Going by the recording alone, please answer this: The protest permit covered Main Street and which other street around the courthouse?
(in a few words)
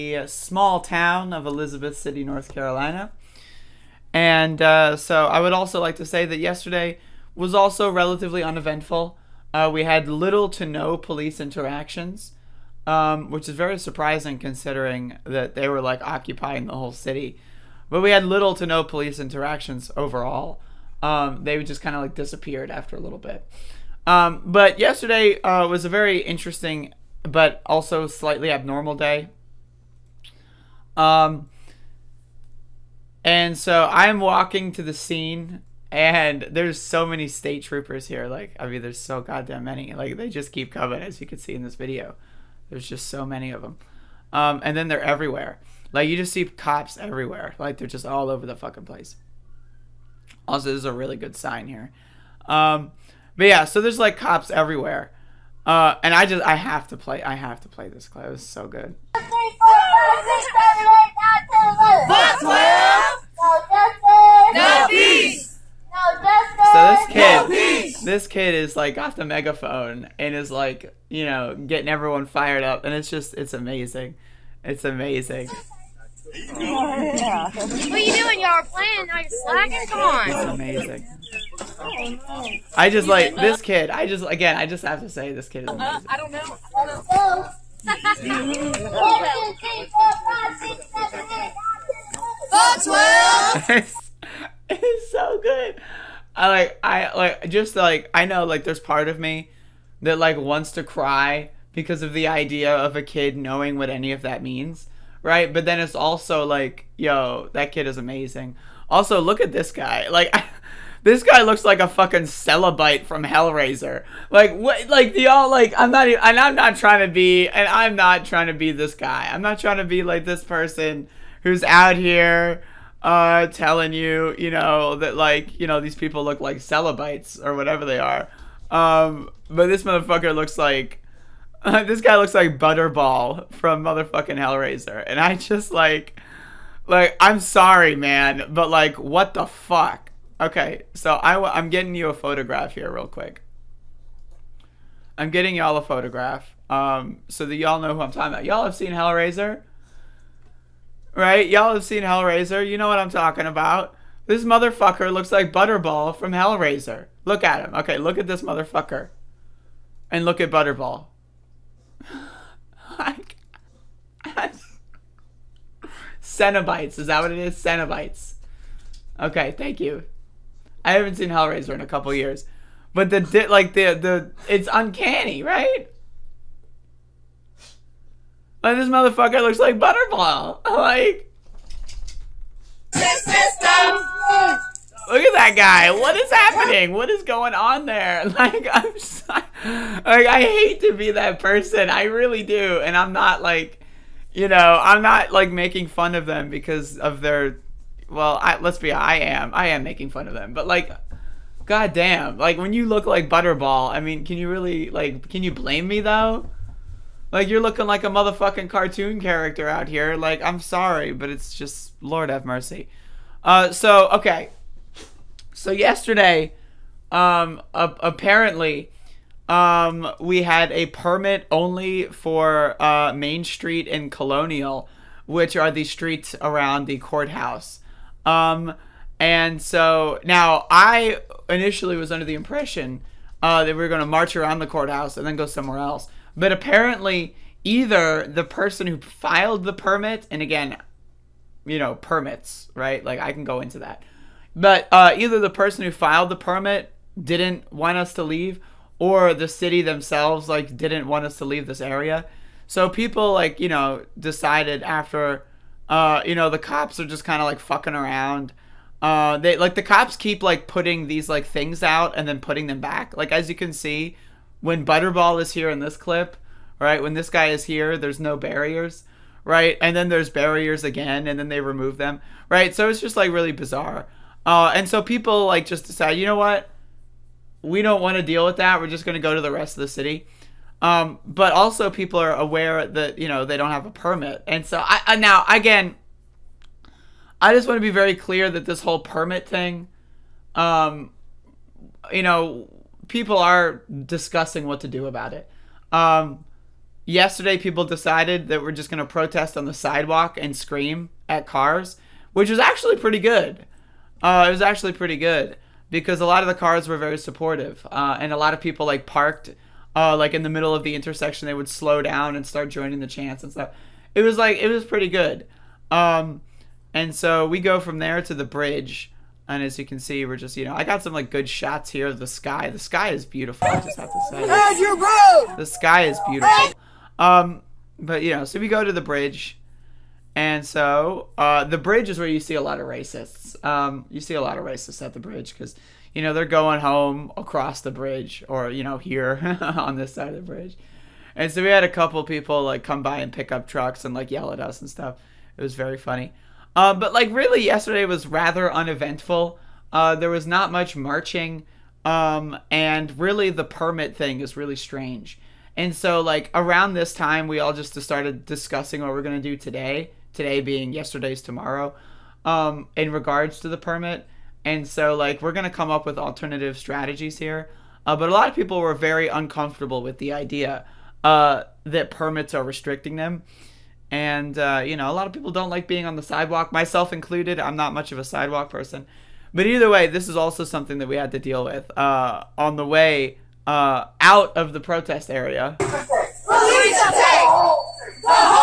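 Colonial.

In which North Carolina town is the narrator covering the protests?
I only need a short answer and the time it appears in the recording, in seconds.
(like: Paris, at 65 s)
Elizabeth City, at 1 s.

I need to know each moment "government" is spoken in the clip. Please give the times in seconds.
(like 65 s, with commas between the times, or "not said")
not said.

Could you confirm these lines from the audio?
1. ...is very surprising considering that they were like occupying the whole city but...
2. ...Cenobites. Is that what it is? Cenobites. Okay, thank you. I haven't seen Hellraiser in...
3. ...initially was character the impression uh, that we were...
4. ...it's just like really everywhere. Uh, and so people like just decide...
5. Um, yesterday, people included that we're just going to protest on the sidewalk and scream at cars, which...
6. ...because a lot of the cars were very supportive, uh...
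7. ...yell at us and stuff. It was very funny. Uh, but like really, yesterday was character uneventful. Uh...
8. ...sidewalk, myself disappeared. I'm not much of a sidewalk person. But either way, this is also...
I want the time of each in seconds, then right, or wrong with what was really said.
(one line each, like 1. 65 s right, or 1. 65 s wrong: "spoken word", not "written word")
1. 13 s right
2. 166 s right
3. 231 s wrong: "under", not "character"
4. 272 s wrong: "bizarre", not "everywhere"
5. 295 s wrong: "decided", not "included"
6. 305 s right
7. 344 s wrong: "rather", not "character"
8. 376 s wrong: "included", not "disappeared".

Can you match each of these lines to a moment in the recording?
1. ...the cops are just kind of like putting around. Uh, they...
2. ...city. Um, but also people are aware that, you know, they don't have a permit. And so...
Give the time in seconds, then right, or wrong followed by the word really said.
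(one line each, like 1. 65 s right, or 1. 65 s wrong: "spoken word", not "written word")
1. 256 s wrong: "fucking", not "putting"
2. 279 s right.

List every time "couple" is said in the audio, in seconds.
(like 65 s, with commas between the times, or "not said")
171 s, 341 s.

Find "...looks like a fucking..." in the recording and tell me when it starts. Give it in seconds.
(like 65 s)
111 s.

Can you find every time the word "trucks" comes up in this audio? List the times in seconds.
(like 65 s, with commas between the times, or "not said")
343 s.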